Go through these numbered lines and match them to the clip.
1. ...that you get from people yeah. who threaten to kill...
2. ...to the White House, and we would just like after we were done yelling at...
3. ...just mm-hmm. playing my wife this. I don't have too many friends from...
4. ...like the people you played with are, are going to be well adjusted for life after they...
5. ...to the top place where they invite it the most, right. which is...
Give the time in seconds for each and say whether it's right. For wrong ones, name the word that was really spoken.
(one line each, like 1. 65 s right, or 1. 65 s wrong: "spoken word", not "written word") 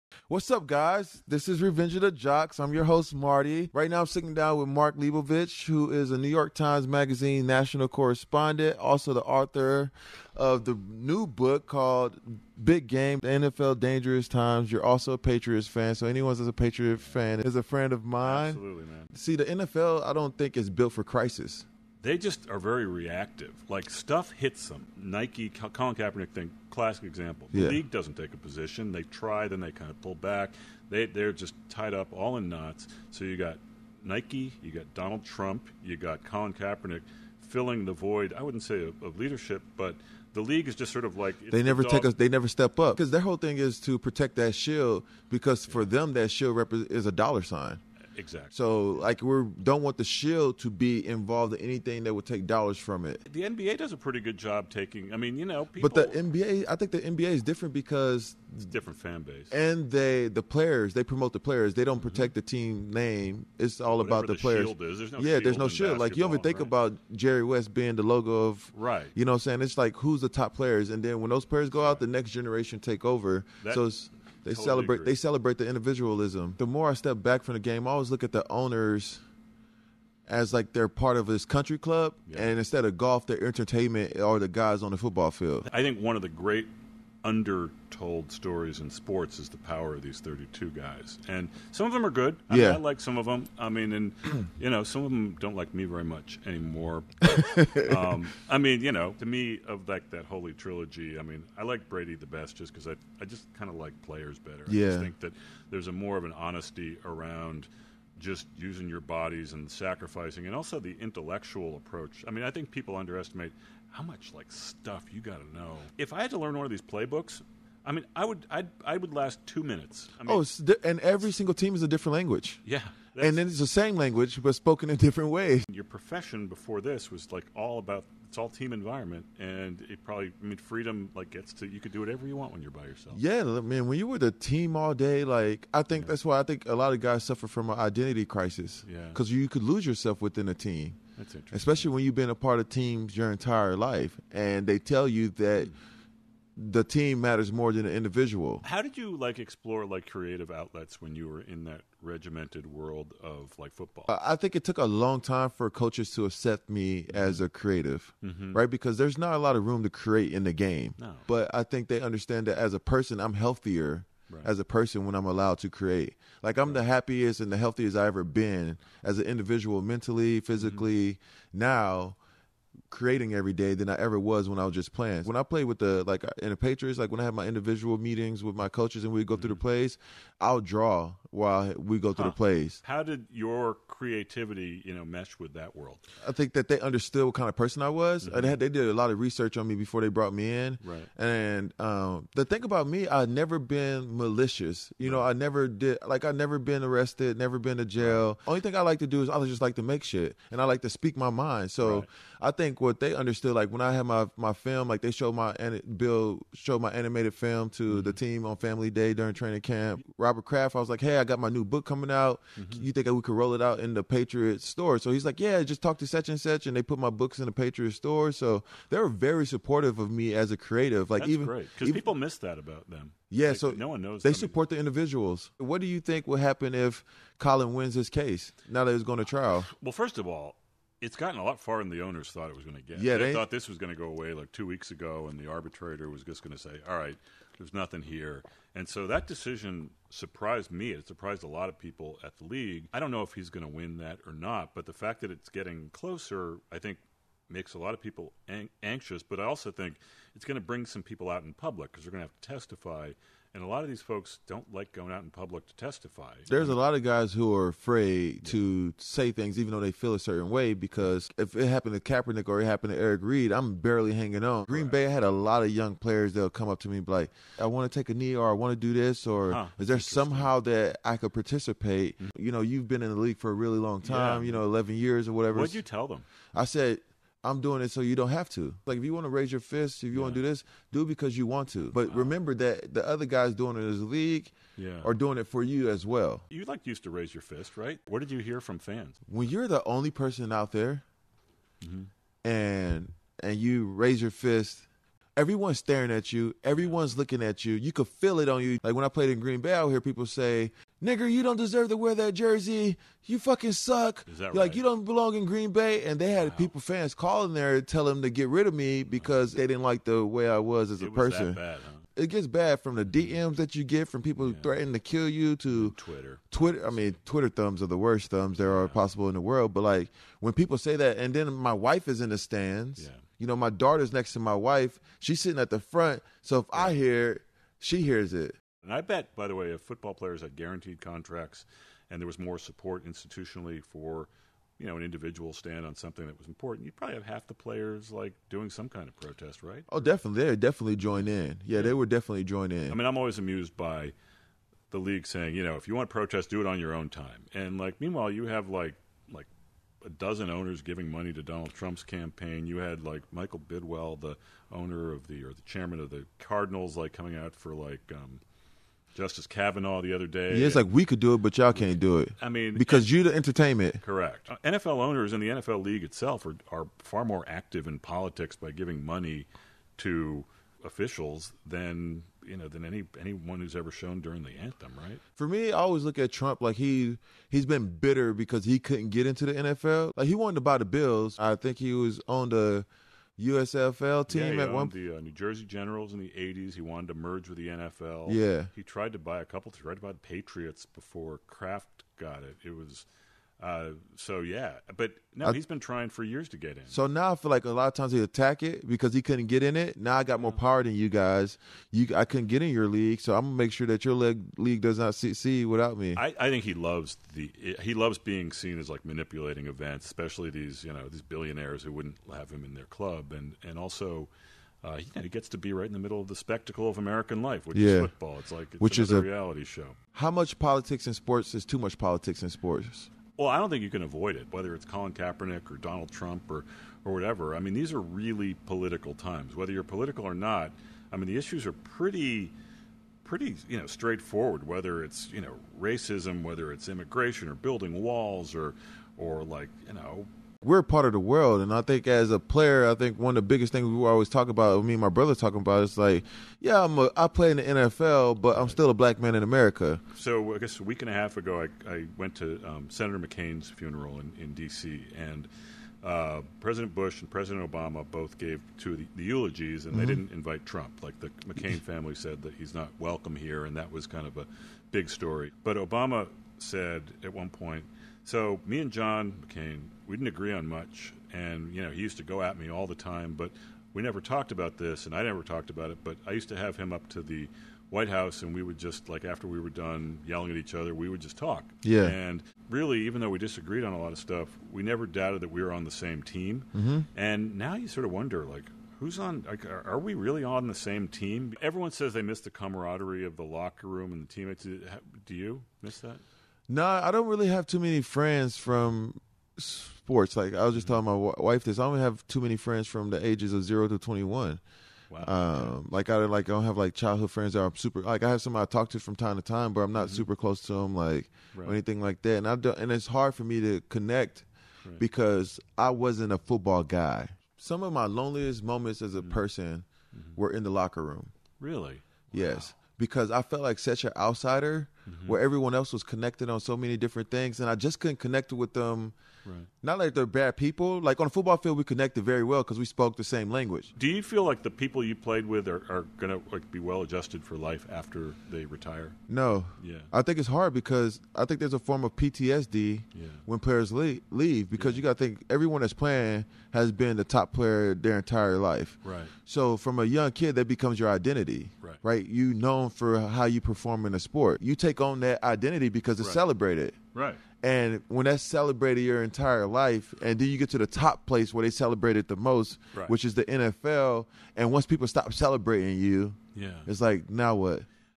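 1. 313 s right
2. 477 s right
3. 500 s wrong: "telling", not "playing"
4. 534 s right
5. 560 s wrong: "celebrate", not "invite".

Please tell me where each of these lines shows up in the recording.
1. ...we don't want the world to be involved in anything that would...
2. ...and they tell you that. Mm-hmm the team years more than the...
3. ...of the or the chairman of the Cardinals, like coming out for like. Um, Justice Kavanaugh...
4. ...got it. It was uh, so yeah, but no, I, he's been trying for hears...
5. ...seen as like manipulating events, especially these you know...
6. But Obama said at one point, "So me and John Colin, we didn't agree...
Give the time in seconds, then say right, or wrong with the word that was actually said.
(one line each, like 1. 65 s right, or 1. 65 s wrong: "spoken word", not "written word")
1. 49 s wrong: "shield", not "world"
2. 144 s wrong: "matters", not "years"
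3. 355 s right
4. 392 s wrong: "years", not "hears"
5. 408 s right
6. 465 s wrong: "McCain", not "Colin".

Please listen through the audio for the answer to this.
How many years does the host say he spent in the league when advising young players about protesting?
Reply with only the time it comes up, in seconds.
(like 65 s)
274 s.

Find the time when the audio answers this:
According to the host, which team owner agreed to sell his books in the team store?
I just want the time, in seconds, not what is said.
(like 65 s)
210 s.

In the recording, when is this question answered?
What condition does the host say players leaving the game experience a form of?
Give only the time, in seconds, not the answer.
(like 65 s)
542 s.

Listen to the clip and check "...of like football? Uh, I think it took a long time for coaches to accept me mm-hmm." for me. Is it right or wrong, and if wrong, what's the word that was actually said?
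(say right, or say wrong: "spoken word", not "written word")
right.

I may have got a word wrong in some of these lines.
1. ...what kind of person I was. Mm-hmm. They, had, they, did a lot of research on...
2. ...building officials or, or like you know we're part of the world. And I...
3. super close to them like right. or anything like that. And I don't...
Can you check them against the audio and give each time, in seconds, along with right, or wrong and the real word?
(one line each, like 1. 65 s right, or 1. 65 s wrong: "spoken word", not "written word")
1. 187 s right
2. 437 s wrong: "walls", not "officials"
3. 510 s right.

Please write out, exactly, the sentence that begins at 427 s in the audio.
I mean, these are really political times.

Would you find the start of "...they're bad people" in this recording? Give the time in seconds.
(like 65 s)
530 s.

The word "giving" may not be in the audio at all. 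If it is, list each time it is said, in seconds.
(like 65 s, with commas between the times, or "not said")
350 s, 368 s.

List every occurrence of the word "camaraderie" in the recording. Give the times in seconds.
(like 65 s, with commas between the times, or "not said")
492 s.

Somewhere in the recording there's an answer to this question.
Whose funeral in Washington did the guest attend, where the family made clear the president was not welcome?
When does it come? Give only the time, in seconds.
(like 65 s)
452 s.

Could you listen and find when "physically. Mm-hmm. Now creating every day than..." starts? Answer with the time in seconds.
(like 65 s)
170 s.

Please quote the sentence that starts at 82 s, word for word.
and instead of golf, they're entertainment or the guys on the football field.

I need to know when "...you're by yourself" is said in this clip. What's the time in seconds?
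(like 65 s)
132 s.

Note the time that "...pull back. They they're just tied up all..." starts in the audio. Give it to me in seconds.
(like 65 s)
30 s.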